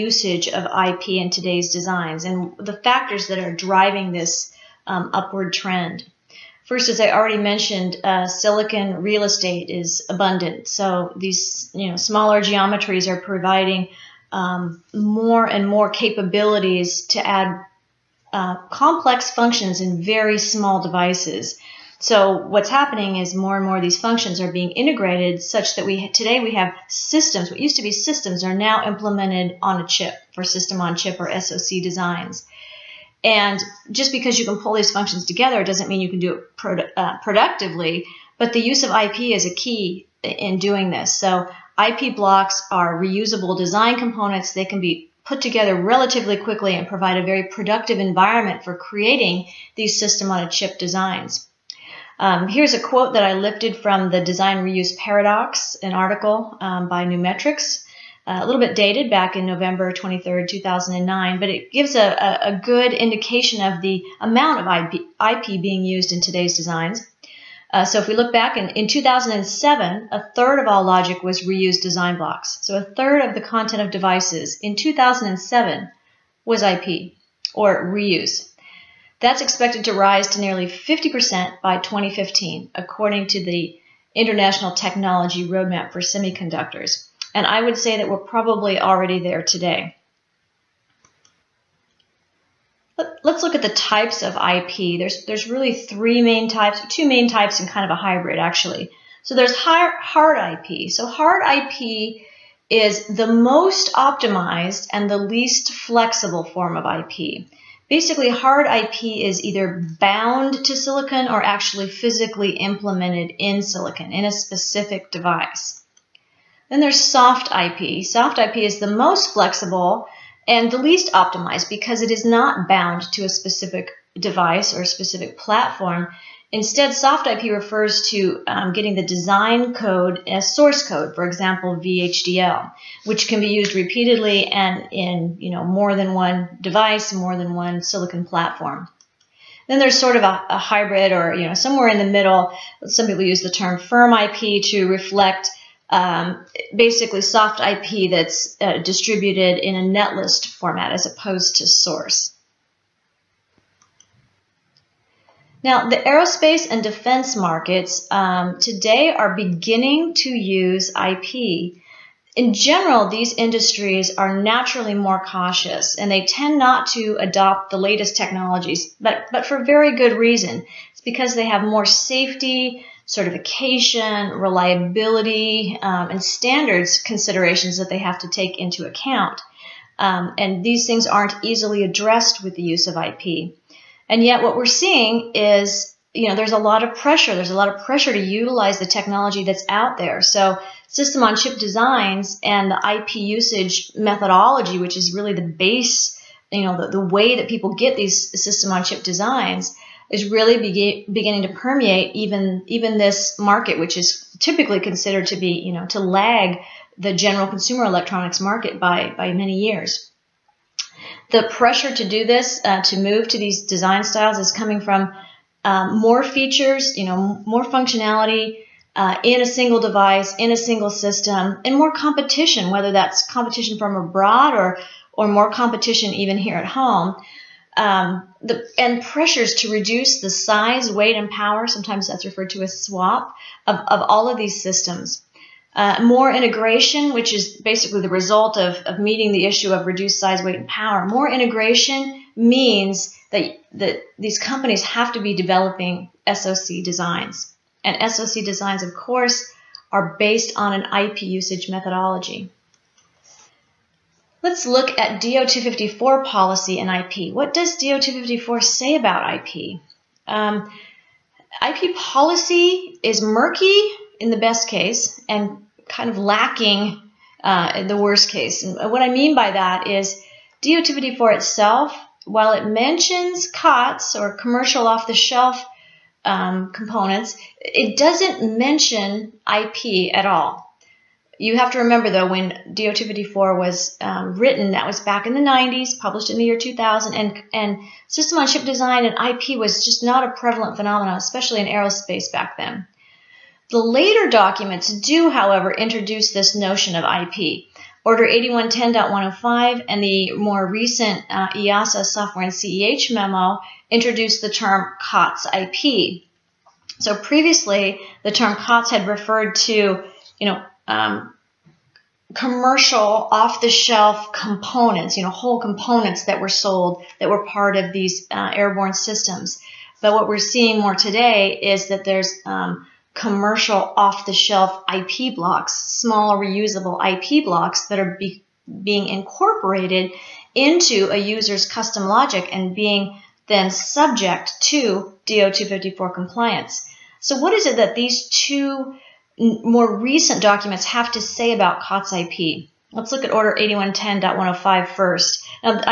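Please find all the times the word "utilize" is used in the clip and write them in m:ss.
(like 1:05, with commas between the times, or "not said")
3:08.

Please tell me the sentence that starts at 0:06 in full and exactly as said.
First, as I already mentioned, uh, silicon real estate is abundant.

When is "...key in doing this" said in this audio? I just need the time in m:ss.
0:39.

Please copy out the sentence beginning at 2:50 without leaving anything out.
It's because they have more safety, certification, reliability, um, and standards considerations that they have to take into account.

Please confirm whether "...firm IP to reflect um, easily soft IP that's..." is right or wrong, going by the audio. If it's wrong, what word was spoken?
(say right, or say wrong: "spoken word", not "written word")
wrong: "basically", not "easily".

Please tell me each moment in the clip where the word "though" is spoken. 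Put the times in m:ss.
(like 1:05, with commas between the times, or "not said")
4:42.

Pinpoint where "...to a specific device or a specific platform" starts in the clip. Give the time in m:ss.
2:03.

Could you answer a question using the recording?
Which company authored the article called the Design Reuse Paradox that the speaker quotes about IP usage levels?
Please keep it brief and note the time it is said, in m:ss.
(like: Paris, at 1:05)
Numetrics, at 0:57.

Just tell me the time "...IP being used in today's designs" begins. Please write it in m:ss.
1:05.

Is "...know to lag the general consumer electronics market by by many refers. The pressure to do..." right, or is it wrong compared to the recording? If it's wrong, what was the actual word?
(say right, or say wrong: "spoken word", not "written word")
wrong: "years", not "refers".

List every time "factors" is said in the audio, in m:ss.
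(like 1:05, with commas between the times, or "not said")
0:02.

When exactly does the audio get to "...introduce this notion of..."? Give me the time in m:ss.
4:55.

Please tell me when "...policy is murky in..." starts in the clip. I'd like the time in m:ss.
4:21.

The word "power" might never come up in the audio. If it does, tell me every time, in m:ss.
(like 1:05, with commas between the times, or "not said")
3:51, 4:00.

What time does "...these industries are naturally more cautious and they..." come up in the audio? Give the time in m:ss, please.
2:43.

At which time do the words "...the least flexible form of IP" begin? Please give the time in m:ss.
1:45.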